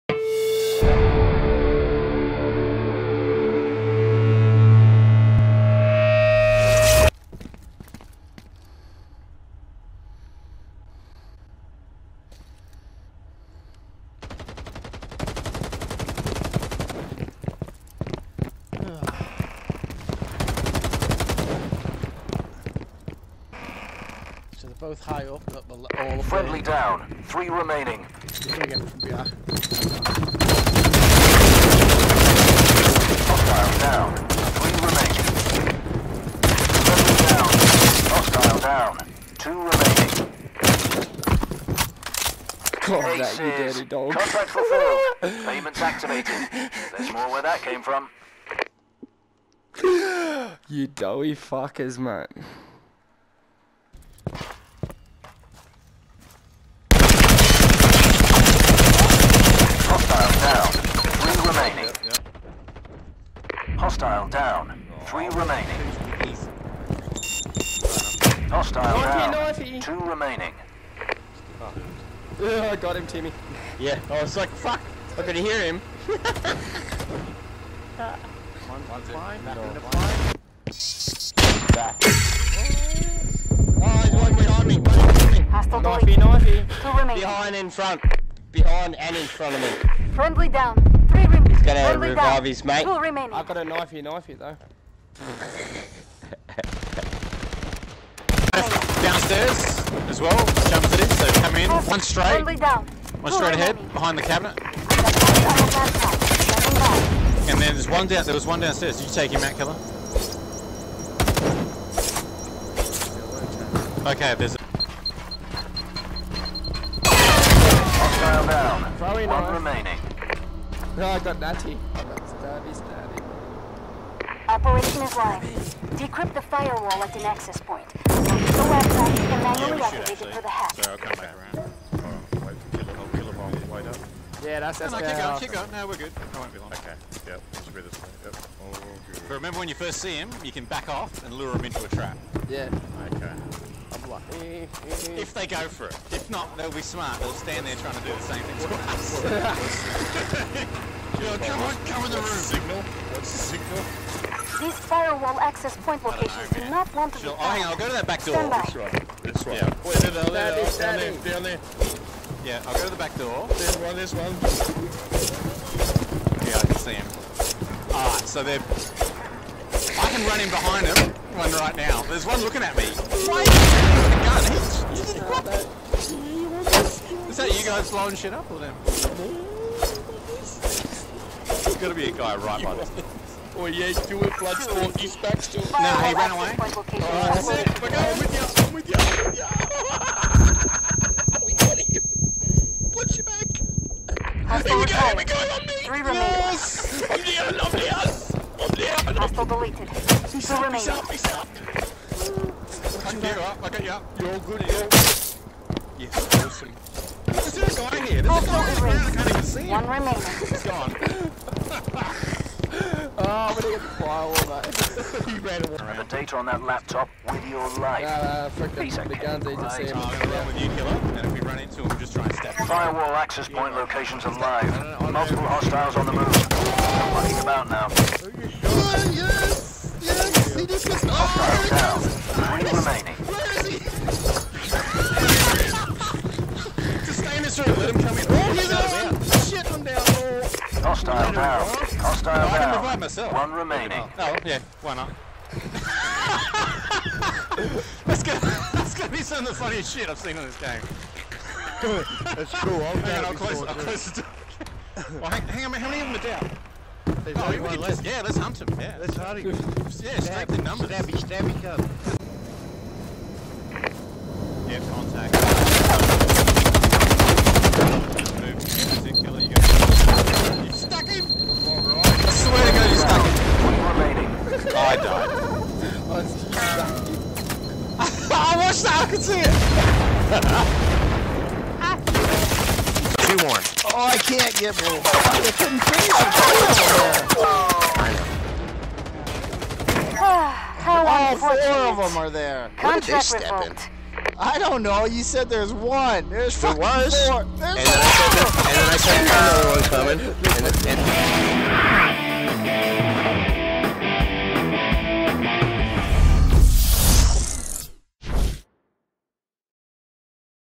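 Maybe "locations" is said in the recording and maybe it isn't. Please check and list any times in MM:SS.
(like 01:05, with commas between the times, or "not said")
02:36, 03:43.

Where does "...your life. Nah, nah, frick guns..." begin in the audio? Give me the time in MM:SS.
03:37.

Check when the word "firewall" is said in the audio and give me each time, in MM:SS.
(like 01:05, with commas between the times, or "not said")
02:06, 02:34, 03:34, 03:42.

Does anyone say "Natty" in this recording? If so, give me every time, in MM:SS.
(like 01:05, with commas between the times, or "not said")
02:01.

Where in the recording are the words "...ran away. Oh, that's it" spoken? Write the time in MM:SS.
03:06.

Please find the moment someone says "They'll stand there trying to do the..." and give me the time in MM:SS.
02:27.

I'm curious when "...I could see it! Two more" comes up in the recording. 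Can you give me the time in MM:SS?
04:38.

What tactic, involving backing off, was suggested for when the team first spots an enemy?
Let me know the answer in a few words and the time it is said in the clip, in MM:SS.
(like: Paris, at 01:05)
Lure him into a trap, at 02:21.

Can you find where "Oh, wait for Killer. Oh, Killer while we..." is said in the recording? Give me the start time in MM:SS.
02:11.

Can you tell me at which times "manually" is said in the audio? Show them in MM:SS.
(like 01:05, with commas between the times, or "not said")
02:09.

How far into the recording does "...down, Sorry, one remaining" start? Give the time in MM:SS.
01:58.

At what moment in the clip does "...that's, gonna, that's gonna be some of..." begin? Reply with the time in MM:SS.
04:08.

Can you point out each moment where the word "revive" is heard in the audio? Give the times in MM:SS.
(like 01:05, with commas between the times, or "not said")
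01:32, 04:02.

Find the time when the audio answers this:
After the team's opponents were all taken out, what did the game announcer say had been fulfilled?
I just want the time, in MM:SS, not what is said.
00:44.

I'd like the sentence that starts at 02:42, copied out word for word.
Yeah, I'll go to the back door.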